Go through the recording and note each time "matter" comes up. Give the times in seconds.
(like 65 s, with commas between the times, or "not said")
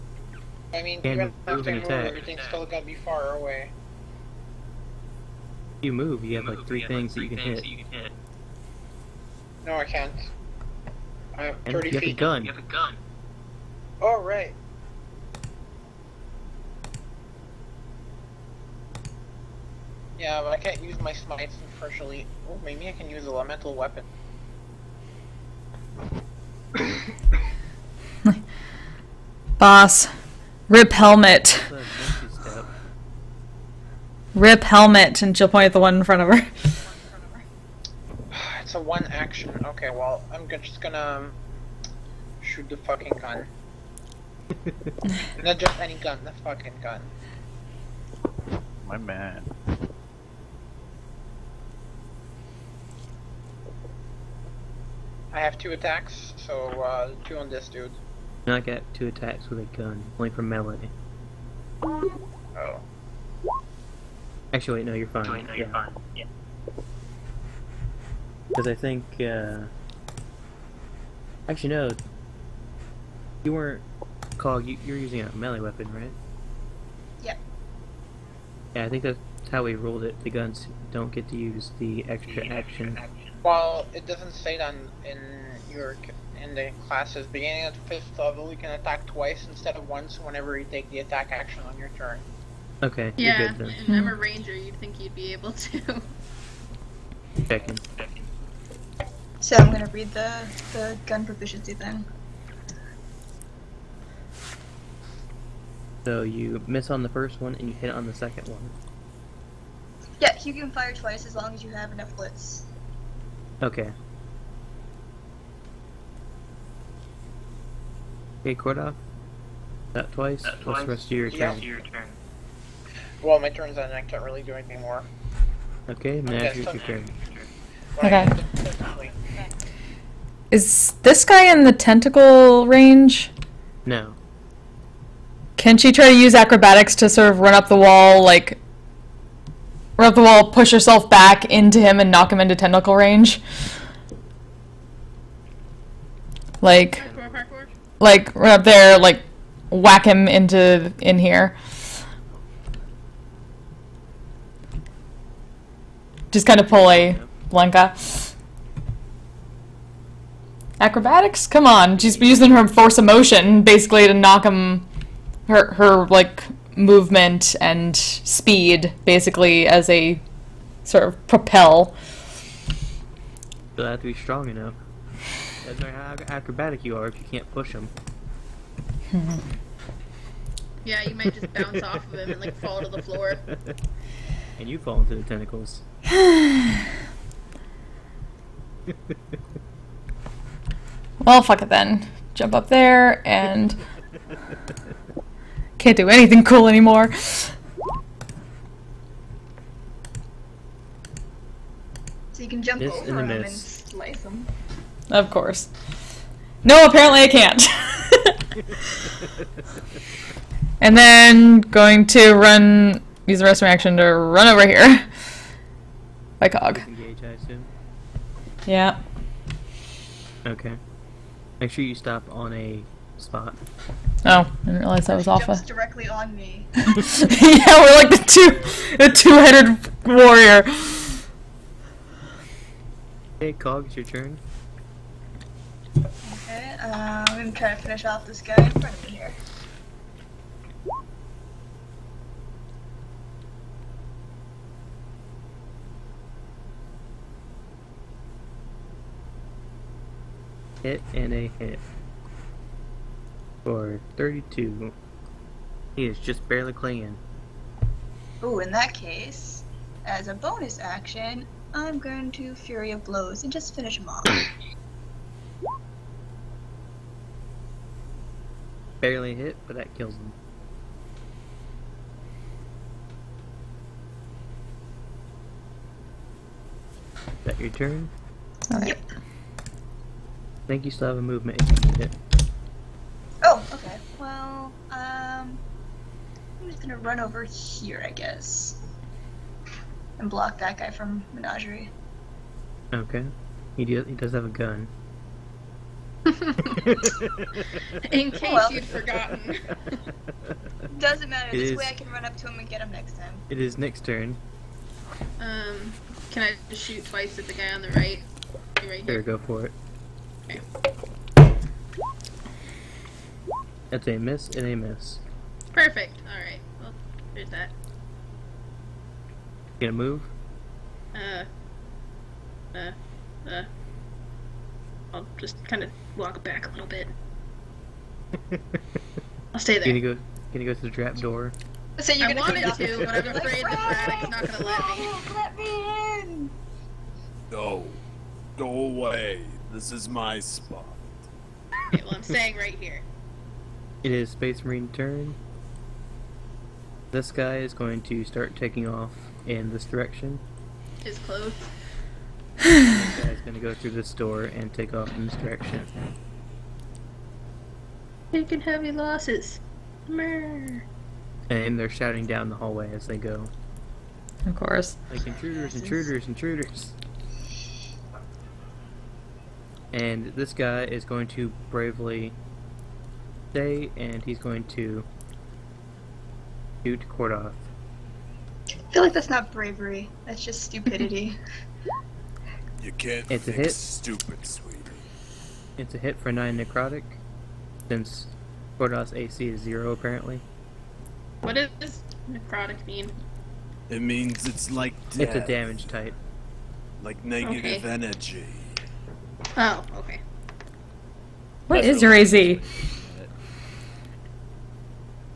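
175 s, 301 s.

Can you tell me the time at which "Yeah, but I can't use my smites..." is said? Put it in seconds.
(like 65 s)
20 s.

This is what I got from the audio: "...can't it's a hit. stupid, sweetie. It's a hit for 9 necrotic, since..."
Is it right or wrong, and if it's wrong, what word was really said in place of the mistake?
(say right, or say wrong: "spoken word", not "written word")
right.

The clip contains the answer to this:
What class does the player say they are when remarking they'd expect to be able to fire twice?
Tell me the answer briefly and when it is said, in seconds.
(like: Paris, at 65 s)
ranger, at 94 s.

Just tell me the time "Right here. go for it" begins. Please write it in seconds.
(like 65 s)
308 s.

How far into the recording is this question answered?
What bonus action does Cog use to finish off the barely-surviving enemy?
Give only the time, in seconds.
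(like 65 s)
262 s.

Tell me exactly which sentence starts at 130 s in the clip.
Is this guy in the tentacle range?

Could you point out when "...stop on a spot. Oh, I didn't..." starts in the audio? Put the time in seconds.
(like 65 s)
221 s.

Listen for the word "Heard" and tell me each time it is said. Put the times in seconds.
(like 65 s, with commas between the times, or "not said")
317 s.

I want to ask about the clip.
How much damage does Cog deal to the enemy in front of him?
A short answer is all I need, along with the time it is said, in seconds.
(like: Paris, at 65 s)
32, at 254 s.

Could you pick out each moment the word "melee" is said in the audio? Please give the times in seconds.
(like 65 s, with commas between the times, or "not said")
60 s, 75 s.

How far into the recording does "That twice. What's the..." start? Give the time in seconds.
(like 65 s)
120 s.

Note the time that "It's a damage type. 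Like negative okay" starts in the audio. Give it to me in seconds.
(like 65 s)
395 s.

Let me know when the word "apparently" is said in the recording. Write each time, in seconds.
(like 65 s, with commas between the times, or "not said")
206 s, 389 s.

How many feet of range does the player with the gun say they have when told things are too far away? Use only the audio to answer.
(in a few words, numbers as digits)
30.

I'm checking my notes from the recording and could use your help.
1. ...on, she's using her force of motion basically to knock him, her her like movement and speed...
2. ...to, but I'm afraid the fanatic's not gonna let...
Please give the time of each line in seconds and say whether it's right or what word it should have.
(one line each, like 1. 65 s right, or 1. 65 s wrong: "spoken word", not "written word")
1. 161 s right
2. 332 s right.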